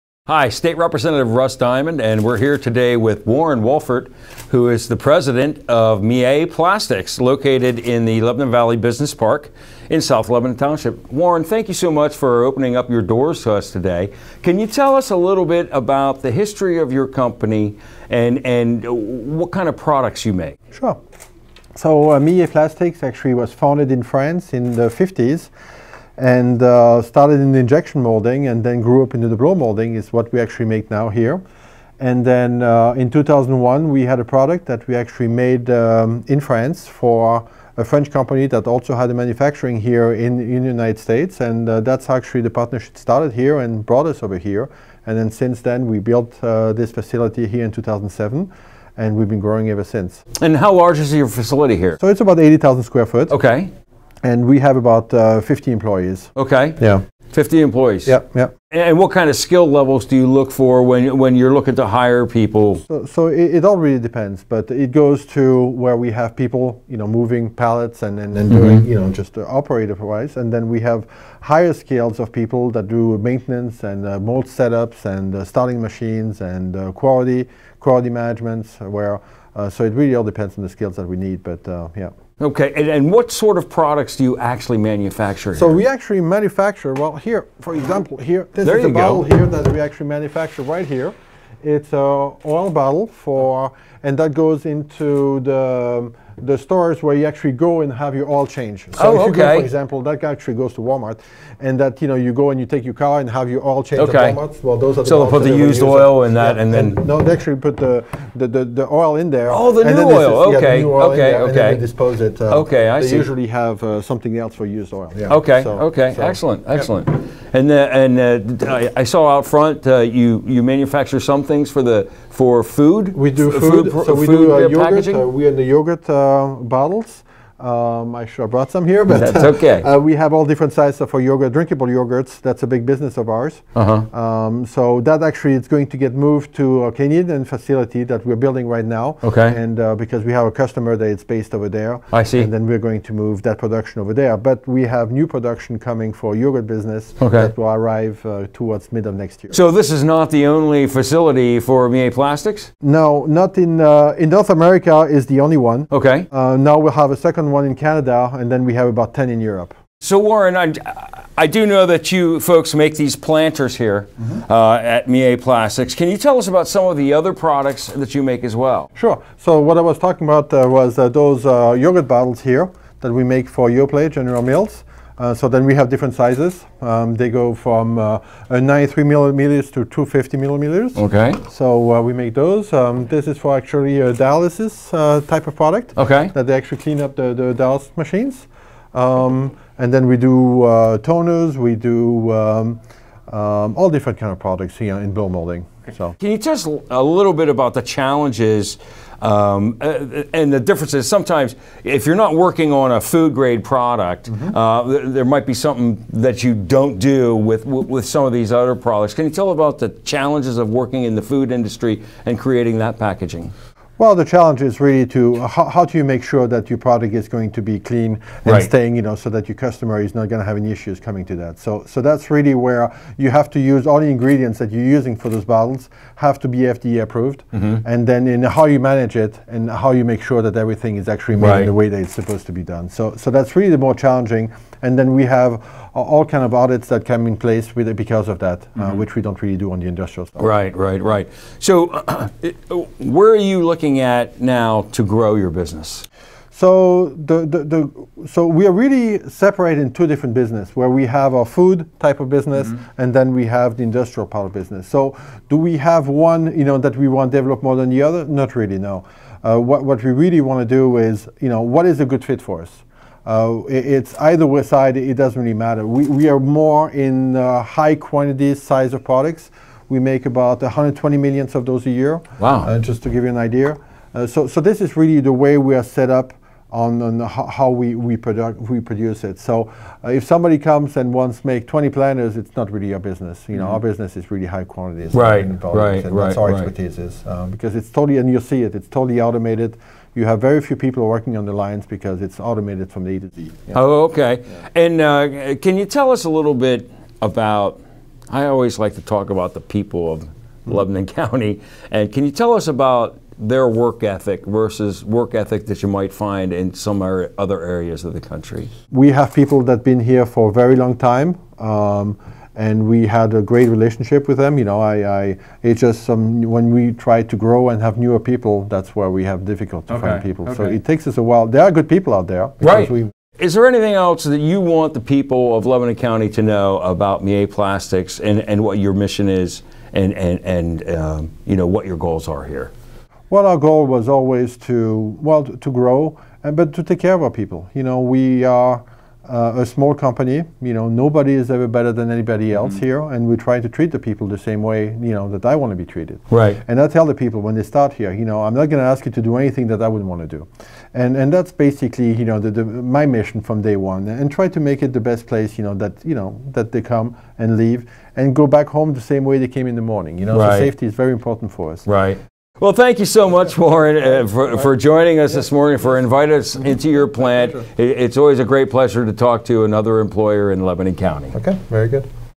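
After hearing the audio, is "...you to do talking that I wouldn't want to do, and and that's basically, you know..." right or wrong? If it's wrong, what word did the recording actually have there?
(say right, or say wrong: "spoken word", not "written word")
wrong: "anything", not "talking".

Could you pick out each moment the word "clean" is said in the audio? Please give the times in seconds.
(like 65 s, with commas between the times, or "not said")
186 s, 217 s.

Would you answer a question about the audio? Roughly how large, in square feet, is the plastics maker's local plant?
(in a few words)
80,000 square feet.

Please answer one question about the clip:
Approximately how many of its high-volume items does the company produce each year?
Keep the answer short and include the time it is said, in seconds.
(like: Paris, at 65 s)
120 million, at 270 s.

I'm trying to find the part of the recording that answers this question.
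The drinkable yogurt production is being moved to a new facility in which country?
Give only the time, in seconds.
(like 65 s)
136 s.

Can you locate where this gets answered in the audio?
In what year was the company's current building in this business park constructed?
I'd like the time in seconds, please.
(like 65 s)
47 s.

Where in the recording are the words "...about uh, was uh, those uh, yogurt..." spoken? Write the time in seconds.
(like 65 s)
170 s.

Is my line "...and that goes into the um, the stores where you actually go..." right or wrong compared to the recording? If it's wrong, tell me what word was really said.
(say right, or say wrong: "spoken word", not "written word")
right.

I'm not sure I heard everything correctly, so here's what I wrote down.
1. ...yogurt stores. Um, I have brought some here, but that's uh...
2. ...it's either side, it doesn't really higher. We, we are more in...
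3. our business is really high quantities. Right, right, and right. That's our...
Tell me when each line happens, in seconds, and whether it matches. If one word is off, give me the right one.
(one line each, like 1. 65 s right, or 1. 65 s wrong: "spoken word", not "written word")
1. 125 s wrong: "bottles", not "stores"
2. 263 s wrong: "matter", not "higher"
3. 283 s right.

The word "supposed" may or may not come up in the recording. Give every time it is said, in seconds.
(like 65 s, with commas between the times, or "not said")
232 s.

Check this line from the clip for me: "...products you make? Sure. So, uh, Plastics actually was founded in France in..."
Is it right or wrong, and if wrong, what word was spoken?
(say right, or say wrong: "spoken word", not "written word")
right.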